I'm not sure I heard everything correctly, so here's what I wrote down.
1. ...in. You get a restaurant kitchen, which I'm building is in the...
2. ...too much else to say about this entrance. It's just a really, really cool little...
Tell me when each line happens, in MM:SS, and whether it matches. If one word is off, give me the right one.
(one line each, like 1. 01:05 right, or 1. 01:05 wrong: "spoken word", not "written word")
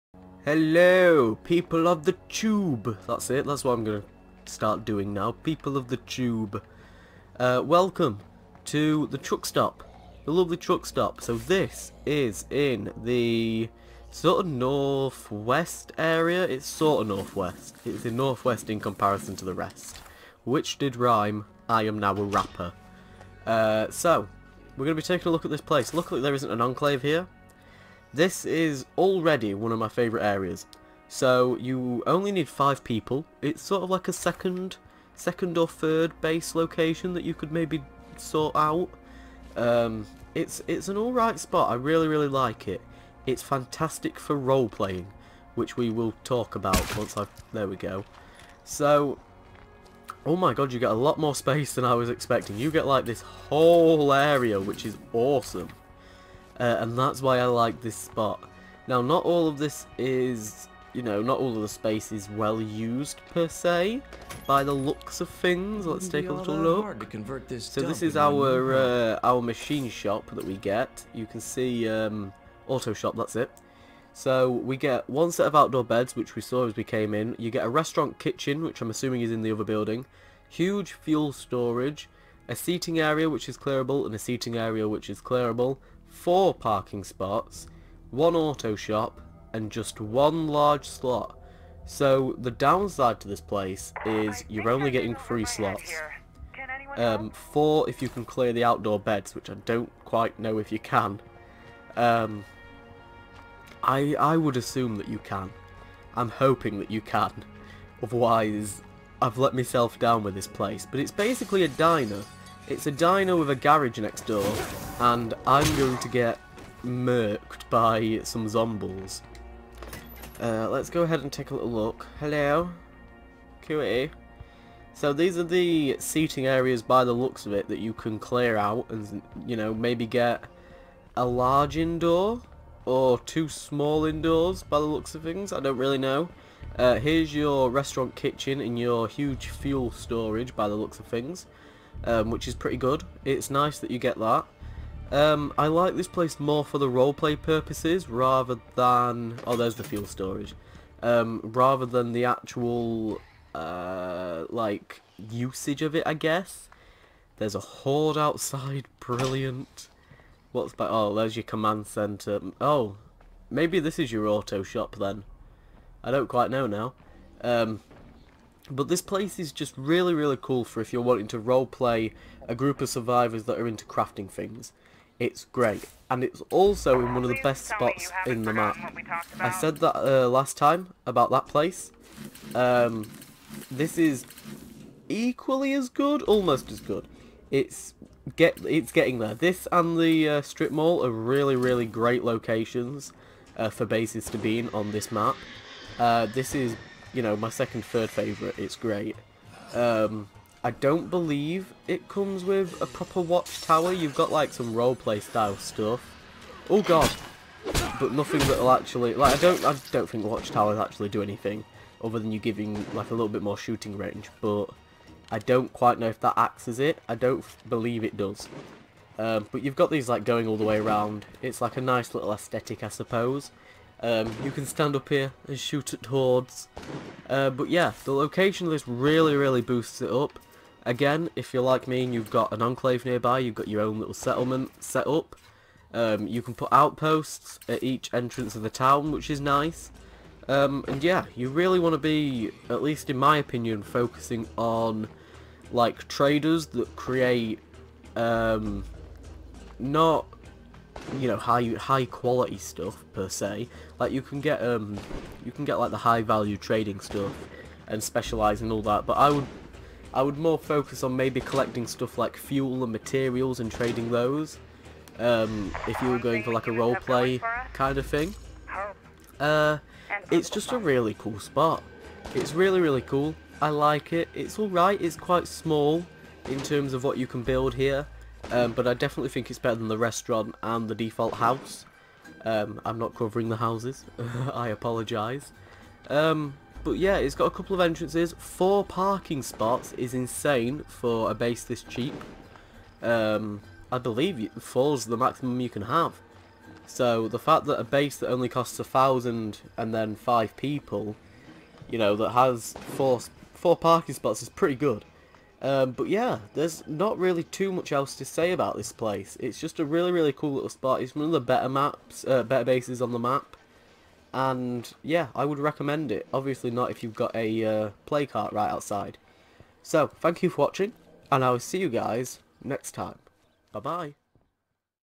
1. 01:17 wrong: "assuming", not "building"
2. 05:07 wrong: "place", not "entrance".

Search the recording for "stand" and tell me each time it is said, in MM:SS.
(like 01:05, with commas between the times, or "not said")
03:44.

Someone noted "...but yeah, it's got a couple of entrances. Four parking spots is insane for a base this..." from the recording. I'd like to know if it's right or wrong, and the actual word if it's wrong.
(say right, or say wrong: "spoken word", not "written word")
right.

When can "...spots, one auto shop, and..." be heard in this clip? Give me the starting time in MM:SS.
01:27.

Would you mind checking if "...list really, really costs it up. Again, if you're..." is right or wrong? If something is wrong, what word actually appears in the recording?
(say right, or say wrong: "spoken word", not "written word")
wrong: "boosts", not "costs".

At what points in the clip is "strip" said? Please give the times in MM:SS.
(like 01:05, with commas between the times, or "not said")
03:10.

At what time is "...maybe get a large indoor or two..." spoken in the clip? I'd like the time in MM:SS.
02:09.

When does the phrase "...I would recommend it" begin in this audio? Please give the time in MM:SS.
05:15.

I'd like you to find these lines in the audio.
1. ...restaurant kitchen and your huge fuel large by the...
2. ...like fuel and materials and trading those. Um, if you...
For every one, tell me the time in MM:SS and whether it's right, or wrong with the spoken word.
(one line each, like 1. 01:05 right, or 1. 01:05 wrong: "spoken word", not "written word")
1. 02:17 wrong: "storage", not "large"
2. 04:22 right.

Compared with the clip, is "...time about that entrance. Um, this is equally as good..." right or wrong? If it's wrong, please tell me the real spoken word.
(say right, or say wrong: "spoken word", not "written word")
wrong: "place", not "entrance".